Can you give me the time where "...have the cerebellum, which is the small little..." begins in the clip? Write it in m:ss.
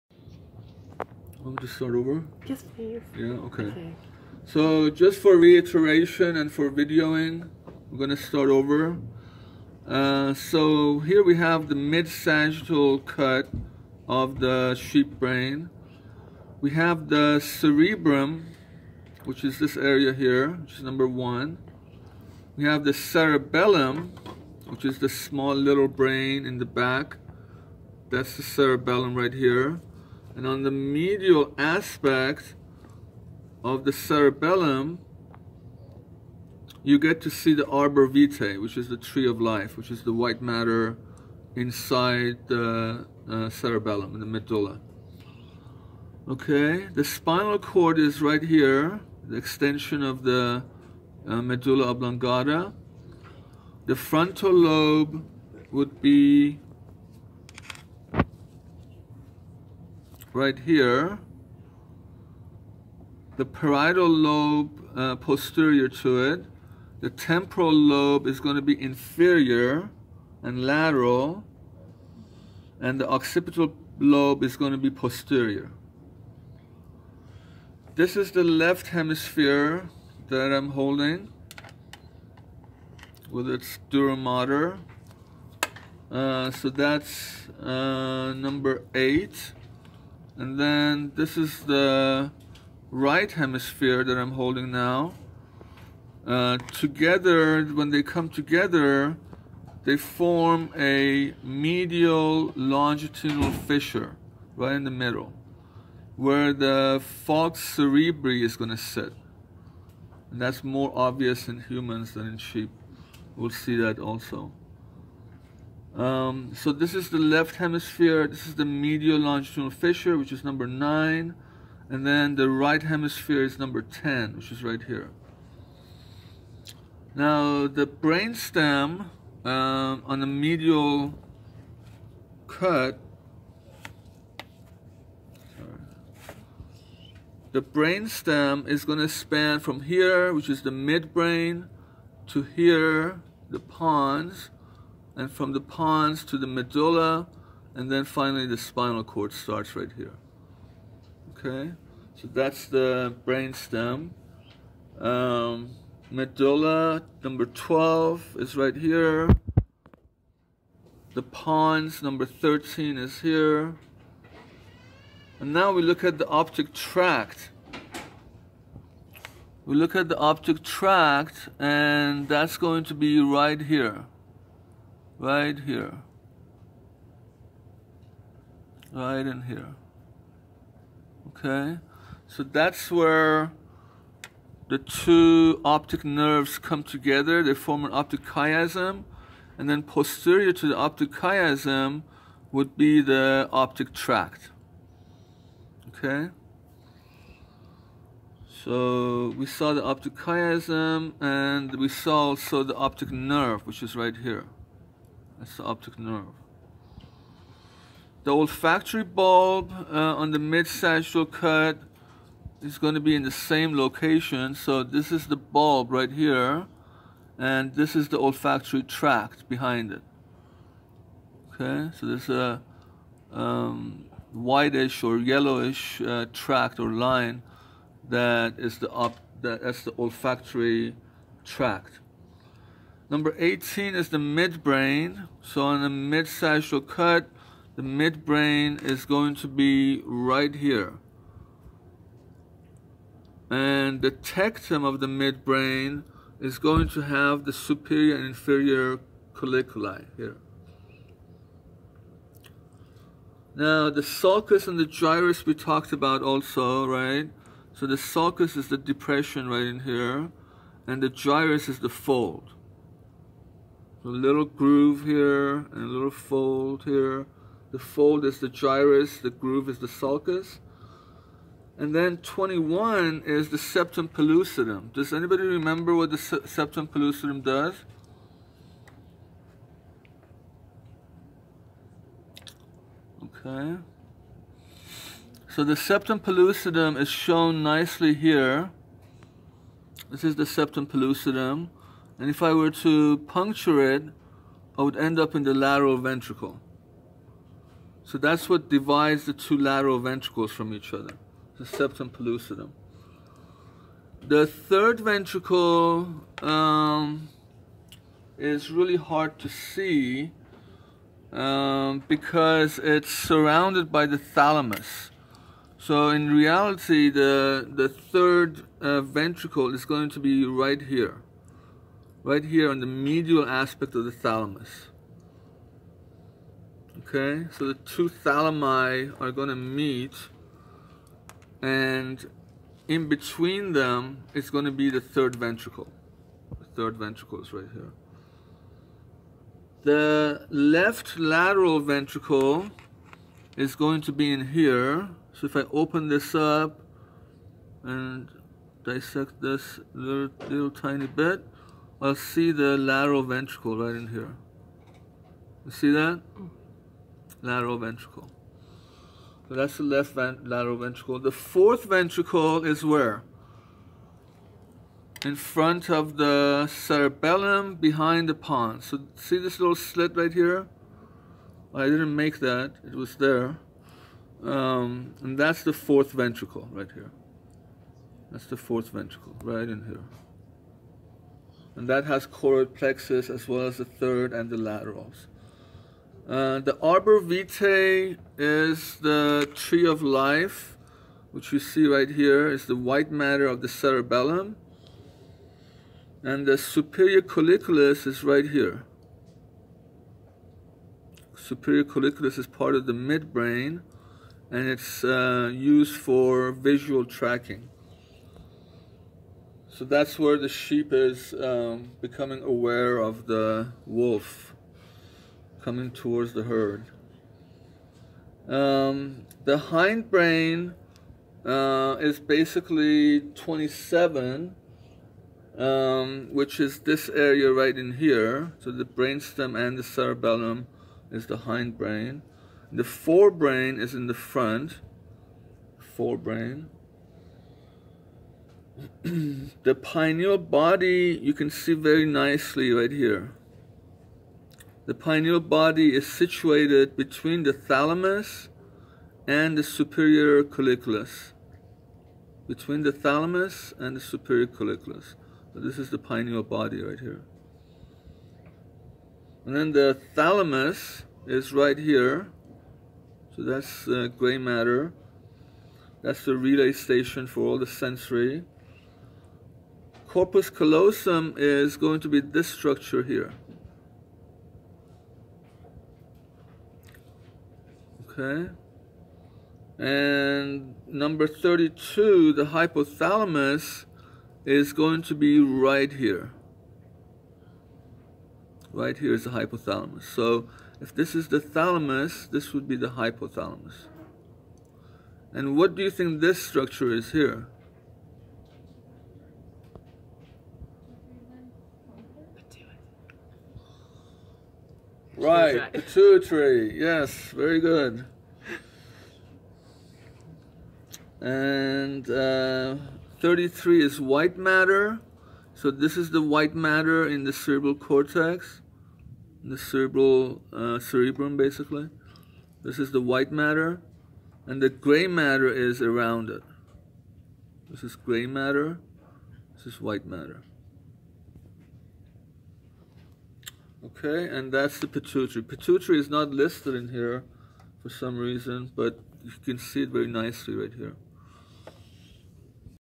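0:22.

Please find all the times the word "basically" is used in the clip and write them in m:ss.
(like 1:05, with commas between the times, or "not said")
7:02, 8:41.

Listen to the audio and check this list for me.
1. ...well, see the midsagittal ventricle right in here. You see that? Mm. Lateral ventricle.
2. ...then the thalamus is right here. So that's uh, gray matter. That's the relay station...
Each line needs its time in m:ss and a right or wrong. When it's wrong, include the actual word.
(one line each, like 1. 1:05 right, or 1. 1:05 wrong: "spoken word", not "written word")
1. 5:52 wrong: "lateral", not "midsagittal"
2. 7:39 right.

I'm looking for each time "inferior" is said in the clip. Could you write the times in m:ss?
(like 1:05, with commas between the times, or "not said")
1:08, 4:08.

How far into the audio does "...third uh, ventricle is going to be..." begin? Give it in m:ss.
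5:17.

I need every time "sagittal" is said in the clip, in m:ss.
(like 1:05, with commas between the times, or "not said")
0:11, 3:30, 3:56.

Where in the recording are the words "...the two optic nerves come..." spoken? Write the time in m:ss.
3:04.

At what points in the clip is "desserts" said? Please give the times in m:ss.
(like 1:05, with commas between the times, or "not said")
not said.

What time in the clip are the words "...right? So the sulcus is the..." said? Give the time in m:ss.
4:16.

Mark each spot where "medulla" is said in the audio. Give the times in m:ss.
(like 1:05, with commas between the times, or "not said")
0:44, 0:51, 2:26, 2:36.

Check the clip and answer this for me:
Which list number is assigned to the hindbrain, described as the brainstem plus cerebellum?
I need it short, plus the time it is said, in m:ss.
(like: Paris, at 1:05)
27, at 7:03.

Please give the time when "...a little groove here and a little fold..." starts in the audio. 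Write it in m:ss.
4:24.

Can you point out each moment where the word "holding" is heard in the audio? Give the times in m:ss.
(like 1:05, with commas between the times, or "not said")
1:20, 1:34.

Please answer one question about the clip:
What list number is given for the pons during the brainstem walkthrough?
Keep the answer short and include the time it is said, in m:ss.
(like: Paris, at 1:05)
13, at 2:42.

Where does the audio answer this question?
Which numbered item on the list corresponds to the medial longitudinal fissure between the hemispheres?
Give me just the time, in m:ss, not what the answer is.
2:00.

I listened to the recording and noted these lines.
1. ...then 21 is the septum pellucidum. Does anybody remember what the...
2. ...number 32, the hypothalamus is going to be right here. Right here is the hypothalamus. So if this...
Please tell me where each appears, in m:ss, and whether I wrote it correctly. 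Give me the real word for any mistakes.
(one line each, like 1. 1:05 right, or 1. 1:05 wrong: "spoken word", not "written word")
1. 4:31 right
2. 8:00 right.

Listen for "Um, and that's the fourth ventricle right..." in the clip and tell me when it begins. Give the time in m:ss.
6:14.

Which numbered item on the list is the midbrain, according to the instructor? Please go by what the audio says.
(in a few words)
18.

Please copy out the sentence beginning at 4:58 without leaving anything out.
So that's what divides the two lateral ventricles from each other, the septum pellucidum.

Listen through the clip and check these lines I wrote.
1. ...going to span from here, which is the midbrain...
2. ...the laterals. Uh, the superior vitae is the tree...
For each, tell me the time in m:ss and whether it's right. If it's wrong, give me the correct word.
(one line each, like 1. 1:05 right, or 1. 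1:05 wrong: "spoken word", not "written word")
1. 2:18 right
2. 6:24 wrong: "arbor", not "superior".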